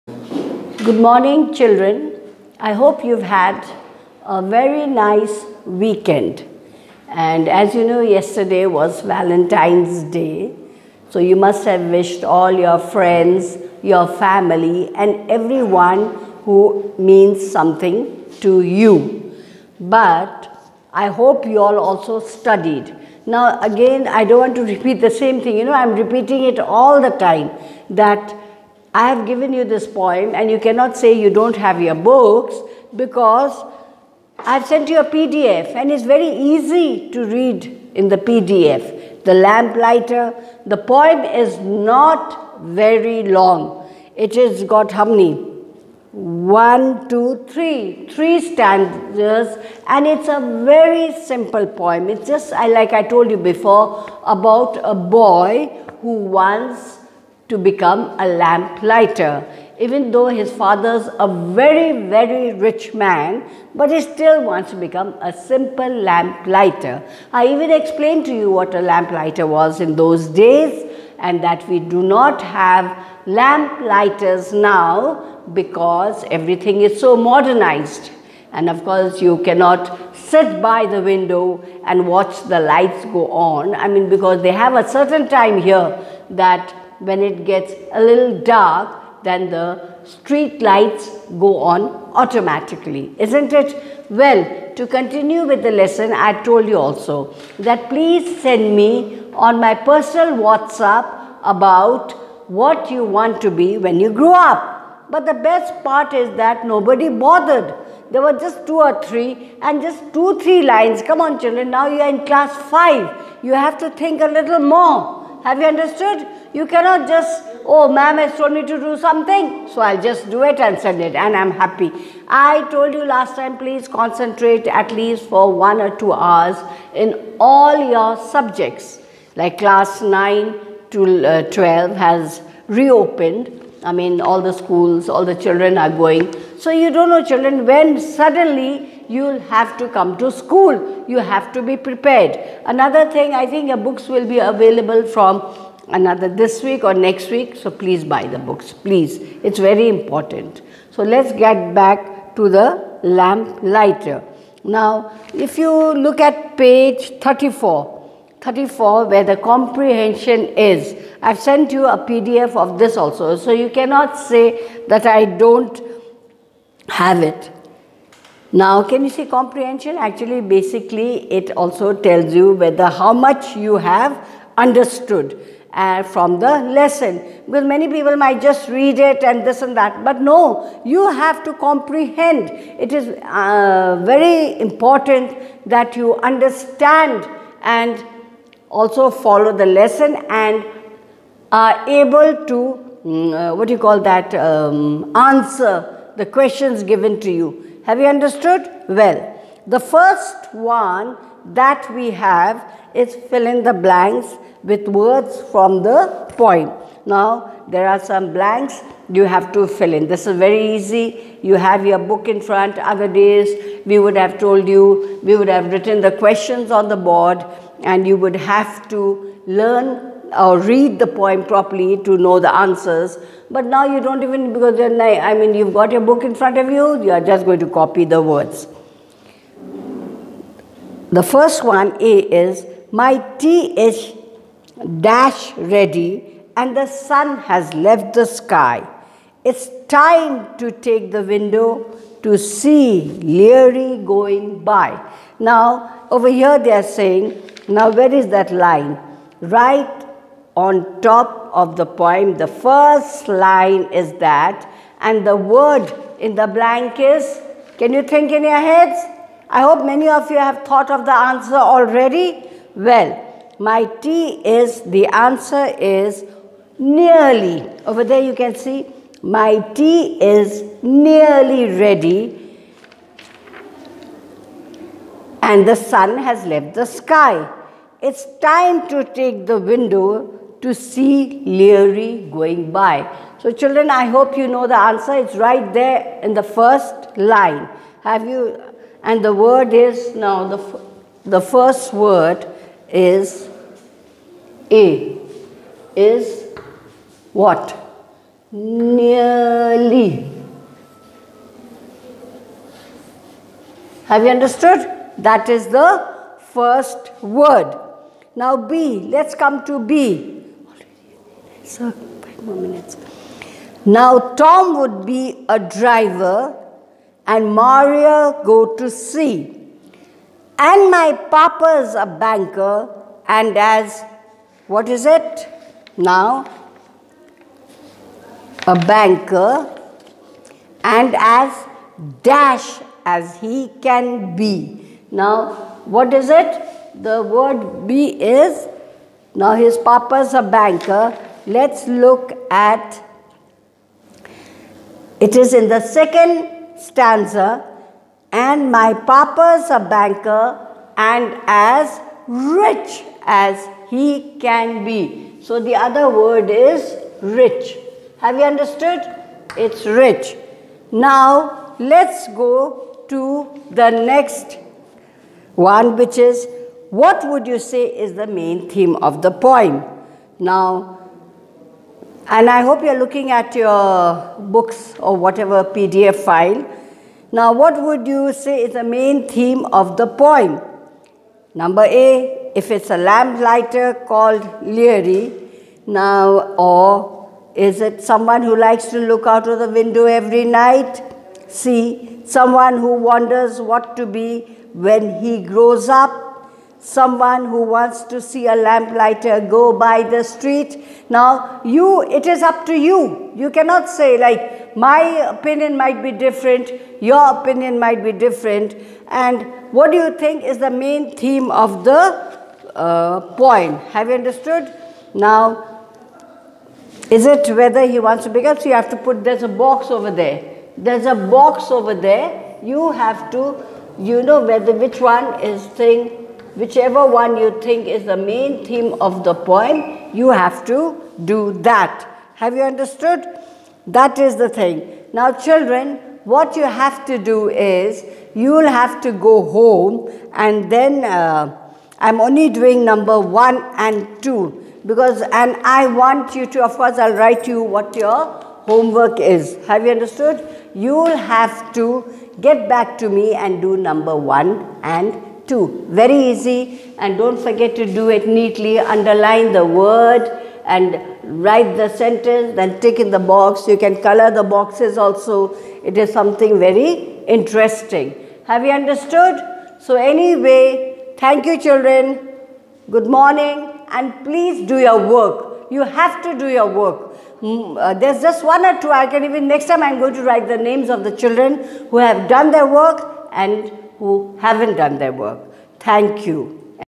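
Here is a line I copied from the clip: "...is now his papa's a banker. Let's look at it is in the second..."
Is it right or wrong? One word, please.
right.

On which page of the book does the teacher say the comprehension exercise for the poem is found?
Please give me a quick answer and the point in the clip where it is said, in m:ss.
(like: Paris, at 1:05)
34, at 2:36.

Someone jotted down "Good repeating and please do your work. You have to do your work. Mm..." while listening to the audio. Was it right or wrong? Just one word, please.
wrong.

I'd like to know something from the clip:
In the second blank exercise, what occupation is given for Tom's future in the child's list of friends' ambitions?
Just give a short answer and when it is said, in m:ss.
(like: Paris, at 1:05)
driver, at 5:15.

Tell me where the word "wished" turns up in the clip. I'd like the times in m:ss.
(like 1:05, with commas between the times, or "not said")
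0:11.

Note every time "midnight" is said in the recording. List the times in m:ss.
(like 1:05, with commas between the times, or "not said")
not said.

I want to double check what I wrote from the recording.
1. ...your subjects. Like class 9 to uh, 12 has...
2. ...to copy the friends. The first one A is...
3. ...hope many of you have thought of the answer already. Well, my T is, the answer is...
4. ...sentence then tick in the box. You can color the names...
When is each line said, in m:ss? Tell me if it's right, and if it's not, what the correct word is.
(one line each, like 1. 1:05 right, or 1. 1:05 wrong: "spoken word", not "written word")
1. 2:07 right
2. 3:47 wrong: "words", not "friends"
3. 4:19 right
4. 7:42 wrong: "boxes", not "names".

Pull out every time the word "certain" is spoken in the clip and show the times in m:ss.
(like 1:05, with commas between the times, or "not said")
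1:24.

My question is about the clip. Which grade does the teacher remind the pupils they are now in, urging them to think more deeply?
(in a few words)
Class 5.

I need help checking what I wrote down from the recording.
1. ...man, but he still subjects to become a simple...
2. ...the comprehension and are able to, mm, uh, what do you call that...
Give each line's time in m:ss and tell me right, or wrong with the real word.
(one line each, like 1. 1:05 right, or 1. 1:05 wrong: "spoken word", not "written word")
1. 1:02 wrong: "wants", not "subjects"
2. 3:09 wrong: "lesson", not "comprehension".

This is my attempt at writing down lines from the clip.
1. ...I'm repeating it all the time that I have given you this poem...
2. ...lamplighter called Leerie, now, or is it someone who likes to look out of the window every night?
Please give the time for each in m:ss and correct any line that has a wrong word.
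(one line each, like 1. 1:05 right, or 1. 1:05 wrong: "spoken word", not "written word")
1. 0:25 right
2. 6:22 right.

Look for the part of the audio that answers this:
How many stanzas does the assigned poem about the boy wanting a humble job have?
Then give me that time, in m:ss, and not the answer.
0:48.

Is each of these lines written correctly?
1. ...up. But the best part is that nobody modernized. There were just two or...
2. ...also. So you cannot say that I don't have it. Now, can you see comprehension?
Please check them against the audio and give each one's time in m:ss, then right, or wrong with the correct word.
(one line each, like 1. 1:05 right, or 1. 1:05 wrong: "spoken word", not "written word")
1. 1:44 wrong: "bothered", not "modernized"
2. 2:42 right.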